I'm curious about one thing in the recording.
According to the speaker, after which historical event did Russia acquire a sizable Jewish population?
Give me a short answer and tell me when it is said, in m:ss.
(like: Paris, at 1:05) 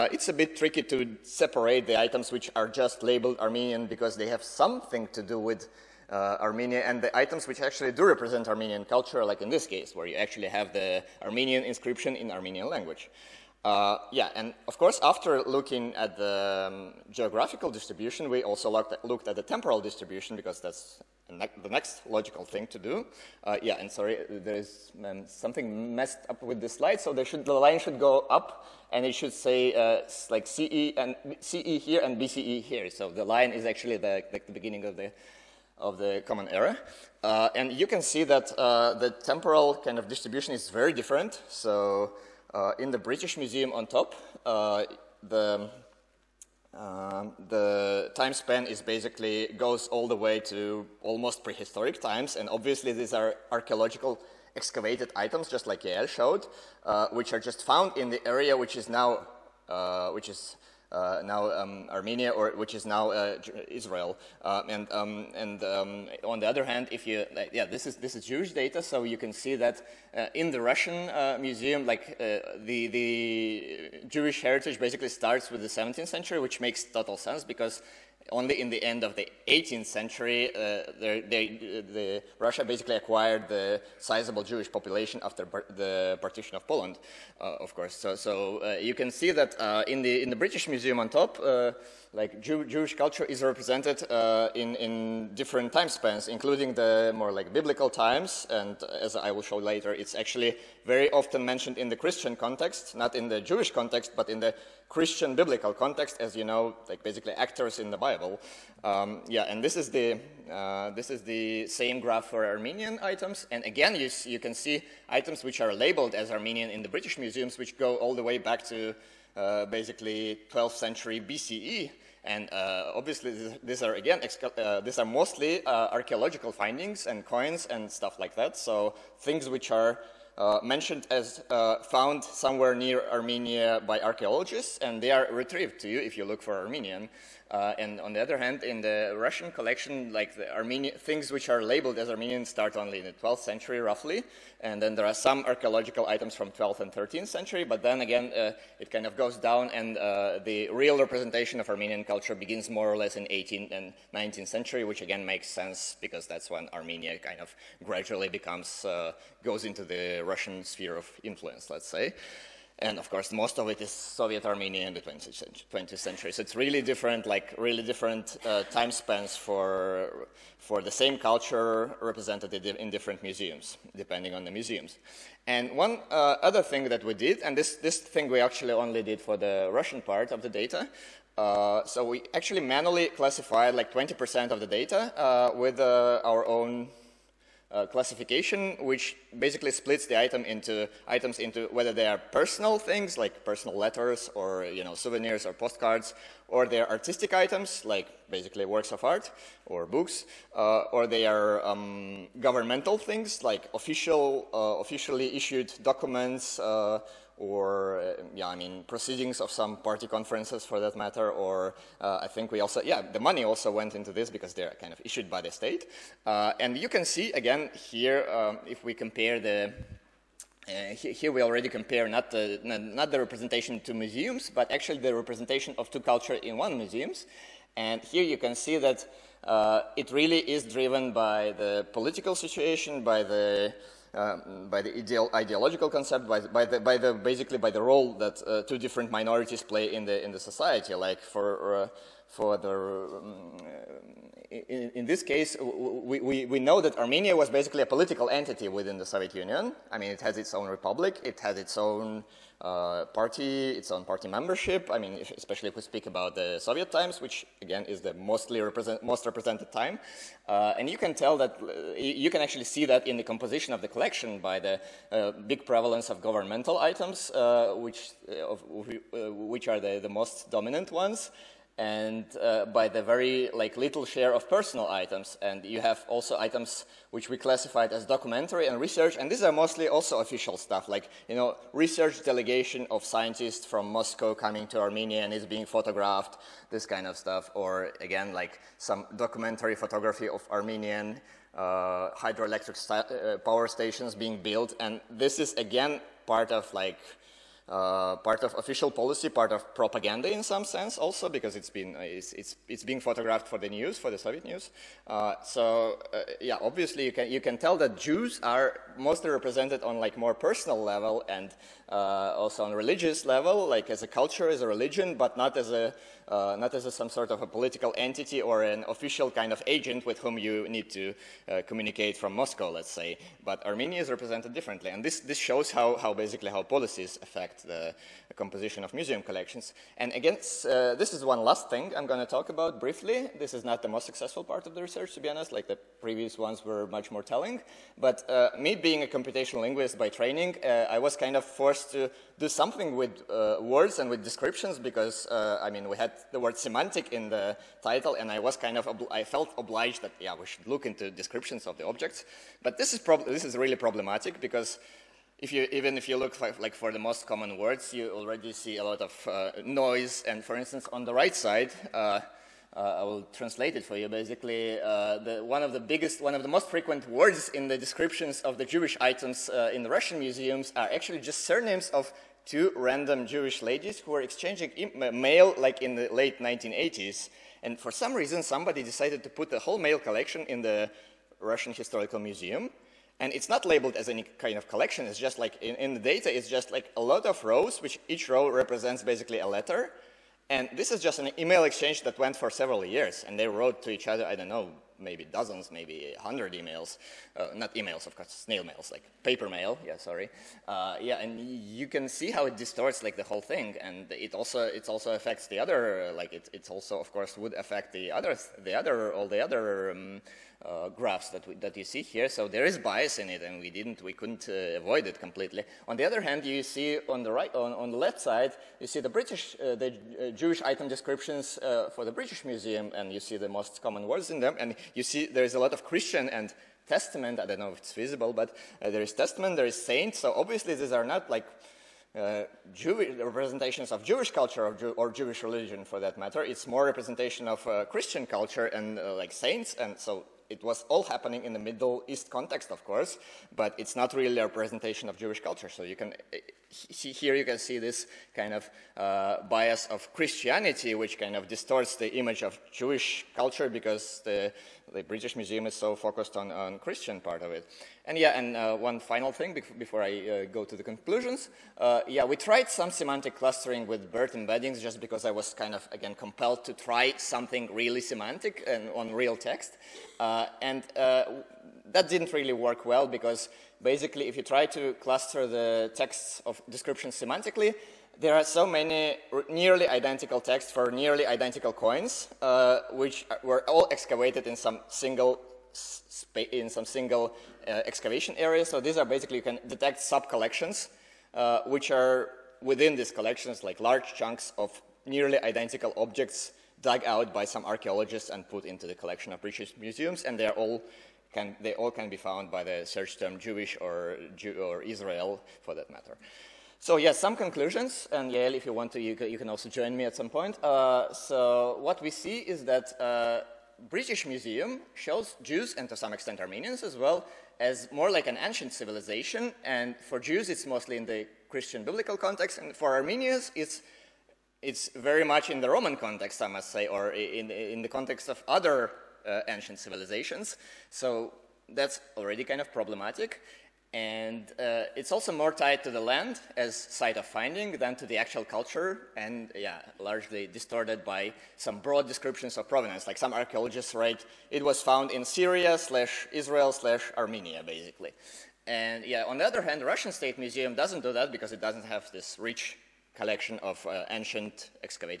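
Partition of Poland, at 1:26.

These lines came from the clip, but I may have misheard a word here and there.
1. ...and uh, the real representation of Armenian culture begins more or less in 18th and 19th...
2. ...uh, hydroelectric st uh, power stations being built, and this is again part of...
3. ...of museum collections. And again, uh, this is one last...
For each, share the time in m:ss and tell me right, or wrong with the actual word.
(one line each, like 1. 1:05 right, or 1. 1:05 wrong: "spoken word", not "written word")
1. 2:29 right
2. 4:51 right
3. 5:28 right.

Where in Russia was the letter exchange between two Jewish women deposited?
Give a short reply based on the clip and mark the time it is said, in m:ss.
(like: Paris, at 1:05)
Russian Historical Museum, at 6:21.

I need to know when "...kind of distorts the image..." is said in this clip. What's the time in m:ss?
7:31.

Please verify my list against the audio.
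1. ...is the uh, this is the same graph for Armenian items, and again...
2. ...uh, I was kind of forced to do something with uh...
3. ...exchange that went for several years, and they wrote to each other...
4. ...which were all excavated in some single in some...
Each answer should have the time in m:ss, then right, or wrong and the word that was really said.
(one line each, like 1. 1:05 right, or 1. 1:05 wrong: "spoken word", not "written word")
1. 1:49 right
2. 5:40 right
3. 6:31 right
4. 8:02 right.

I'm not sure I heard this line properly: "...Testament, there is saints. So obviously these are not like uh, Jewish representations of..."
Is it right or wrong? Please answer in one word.
right.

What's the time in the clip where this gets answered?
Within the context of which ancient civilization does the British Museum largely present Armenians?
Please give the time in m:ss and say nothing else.
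8:45.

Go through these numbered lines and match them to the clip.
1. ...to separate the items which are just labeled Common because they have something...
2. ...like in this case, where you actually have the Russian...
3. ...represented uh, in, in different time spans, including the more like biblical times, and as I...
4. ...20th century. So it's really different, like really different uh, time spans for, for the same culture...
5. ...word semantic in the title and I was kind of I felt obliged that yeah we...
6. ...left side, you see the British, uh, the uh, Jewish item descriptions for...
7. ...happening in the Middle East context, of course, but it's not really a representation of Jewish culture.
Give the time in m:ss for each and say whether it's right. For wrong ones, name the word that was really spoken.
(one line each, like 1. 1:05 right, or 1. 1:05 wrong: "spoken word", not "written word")
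1. 0:00 wrong: "Armenian", not "Common"
2. 0:09 wrong: "Armenian", not "Russian"
3. 1:33 right
4. 2:45 right
5. 5:46 right
6. 6:57 right
7. 7:21 right.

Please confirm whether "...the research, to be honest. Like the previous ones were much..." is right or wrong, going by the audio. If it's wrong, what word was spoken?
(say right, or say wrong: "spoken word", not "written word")
right.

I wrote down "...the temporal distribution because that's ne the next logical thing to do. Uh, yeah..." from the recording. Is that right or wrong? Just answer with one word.
right.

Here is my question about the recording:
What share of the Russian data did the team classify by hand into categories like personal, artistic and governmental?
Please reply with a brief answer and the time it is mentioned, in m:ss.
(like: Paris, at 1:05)
20%, at 3:03.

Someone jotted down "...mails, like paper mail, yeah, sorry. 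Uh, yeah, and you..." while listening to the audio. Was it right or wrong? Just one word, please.
right.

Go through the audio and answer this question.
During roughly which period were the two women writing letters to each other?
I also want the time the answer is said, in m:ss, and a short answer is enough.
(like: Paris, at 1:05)
Late 1980s, at 6:16.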